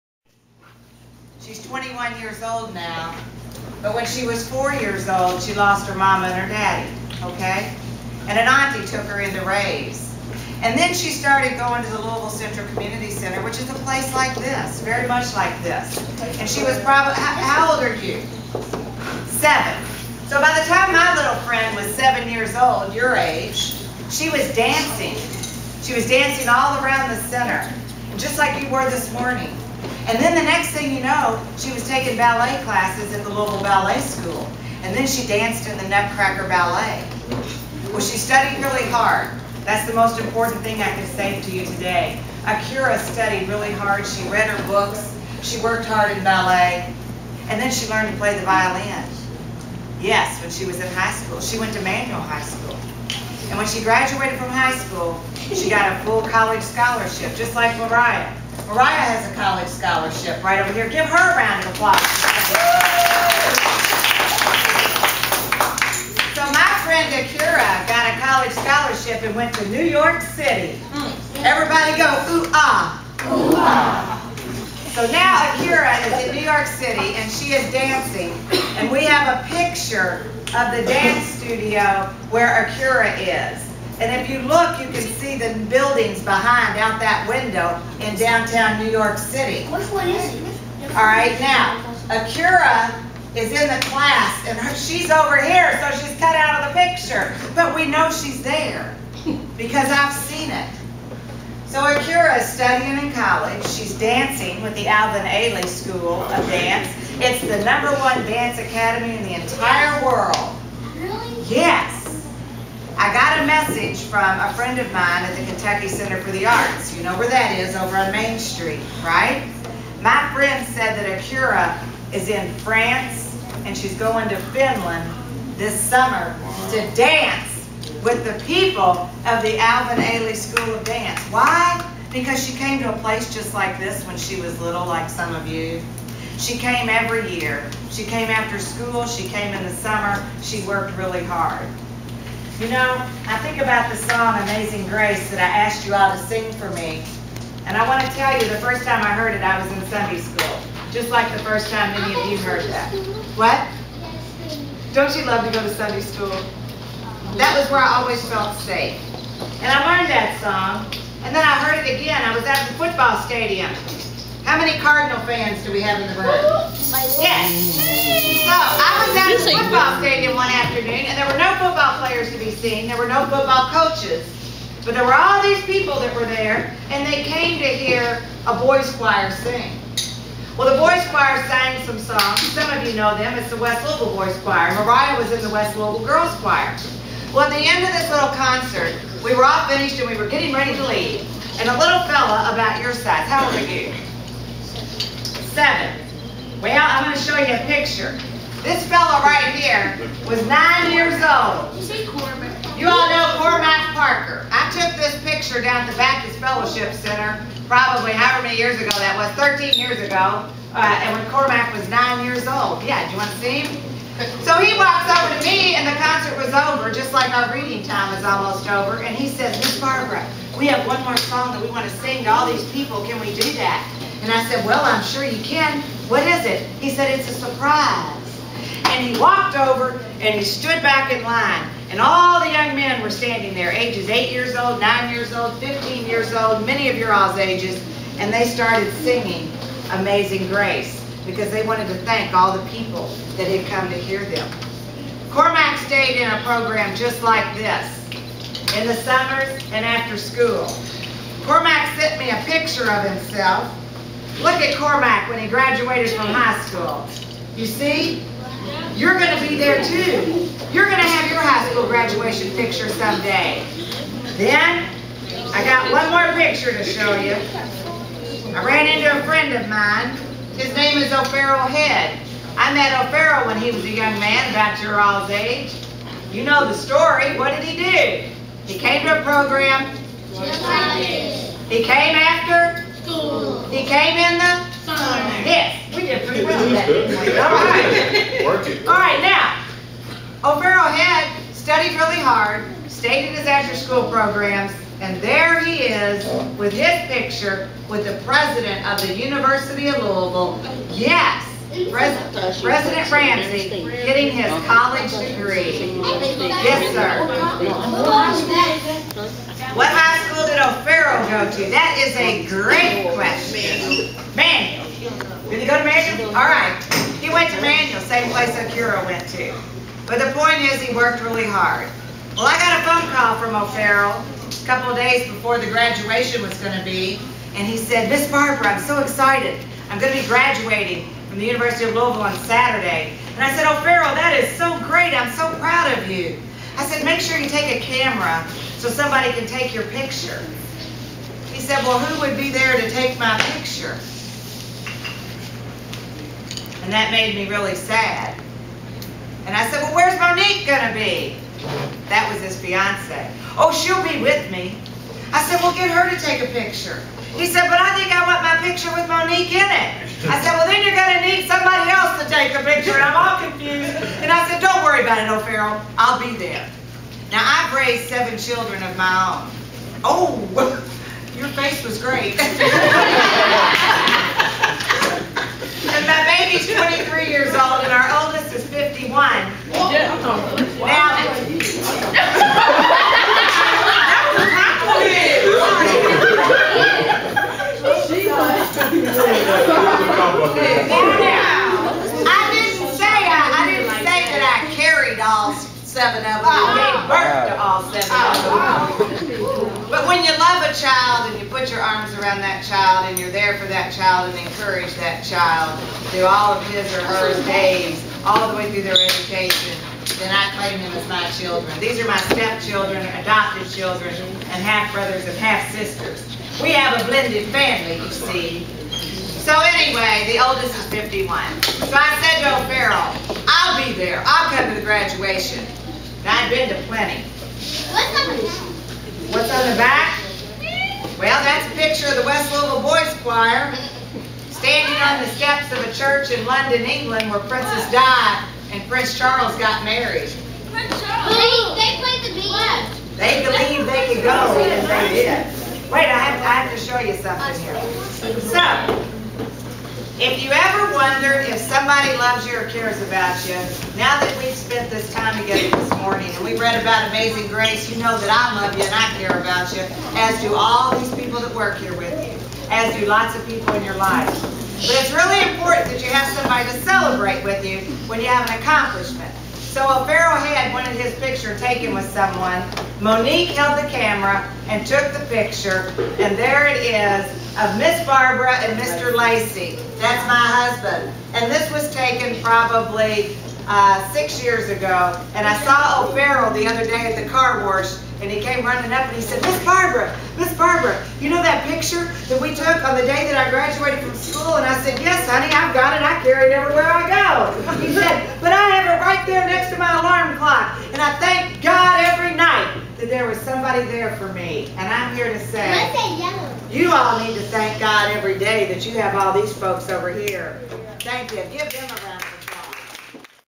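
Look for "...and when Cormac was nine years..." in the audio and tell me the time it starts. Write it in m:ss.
3:31.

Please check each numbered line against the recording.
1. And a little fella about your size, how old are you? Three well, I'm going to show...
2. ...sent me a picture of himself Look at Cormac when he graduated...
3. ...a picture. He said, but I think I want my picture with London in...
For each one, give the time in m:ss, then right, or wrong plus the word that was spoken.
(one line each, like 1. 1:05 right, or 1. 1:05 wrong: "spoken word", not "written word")
1. 3:11 wrong: "Seven", not "Three"
2. 4:11 right
3. 5:56 wrong: "Monique", not "London".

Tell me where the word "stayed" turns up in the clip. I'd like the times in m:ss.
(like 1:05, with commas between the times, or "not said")
4:05, 4:52.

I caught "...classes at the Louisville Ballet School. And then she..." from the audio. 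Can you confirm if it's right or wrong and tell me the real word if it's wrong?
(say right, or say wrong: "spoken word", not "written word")
right.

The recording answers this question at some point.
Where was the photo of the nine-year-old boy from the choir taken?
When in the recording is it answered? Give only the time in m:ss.
3:25.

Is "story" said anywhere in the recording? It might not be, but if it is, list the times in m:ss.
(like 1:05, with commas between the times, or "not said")
4:36.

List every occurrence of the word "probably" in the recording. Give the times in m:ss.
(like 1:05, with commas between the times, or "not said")
0:16, 3:27, 8:02.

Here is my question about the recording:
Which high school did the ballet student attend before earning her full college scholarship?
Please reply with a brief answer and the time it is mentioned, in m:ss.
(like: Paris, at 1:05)
Manual High School, at 0:51.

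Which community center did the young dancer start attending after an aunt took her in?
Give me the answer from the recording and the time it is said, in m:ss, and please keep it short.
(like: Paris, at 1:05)
Louisville Central Community Center, at 0:11.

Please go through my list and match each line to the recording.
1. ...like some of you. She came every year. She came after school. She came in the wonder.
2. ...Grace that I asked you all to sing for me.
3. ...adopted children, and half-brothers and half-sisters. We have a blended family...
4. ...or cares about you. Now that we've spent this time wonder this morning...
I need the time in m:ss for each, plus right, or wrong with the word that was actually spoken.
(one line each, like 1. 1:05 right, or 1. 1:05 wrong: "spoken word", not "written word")
1. 2:14 wrong: "summer", not "wonder"
2. 2:24 right
3. 6:53 right
4. 7:32 wrong: "together", not "wonder".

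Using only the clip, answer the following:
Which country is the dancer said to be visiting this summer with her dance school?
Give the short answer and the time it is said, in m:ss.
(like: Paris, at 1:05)
Finland, at 2:04.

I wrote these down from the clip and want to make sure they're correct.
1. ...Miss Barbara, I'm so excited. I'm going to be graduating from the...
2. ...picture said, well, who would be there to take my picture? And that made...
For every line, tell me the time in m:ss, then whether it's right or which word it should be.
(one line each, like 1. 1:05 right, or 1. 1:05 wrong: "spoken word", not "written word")
1. 5:28 right
2. 5:39 right.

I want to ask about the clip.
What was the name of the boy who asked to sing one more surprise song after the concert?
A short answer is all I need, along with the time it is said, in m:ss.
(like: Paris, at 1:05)
Cormac Parker, at 3:23.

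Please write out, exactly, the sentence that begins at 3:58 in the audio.
And they started singing Amazing Grace because they wanted to thank all the people that had come to hear them.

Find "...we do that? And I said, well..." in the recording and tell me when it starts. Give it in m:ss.
3:43.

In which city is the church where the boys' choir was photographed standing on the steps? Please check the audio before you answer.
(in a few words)
London.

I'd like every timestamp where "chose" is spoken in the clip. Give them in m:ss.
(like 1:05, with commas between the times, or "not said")
not said.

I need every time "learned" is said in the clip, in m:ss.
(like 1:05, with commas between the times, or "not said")
0:47, 2:39.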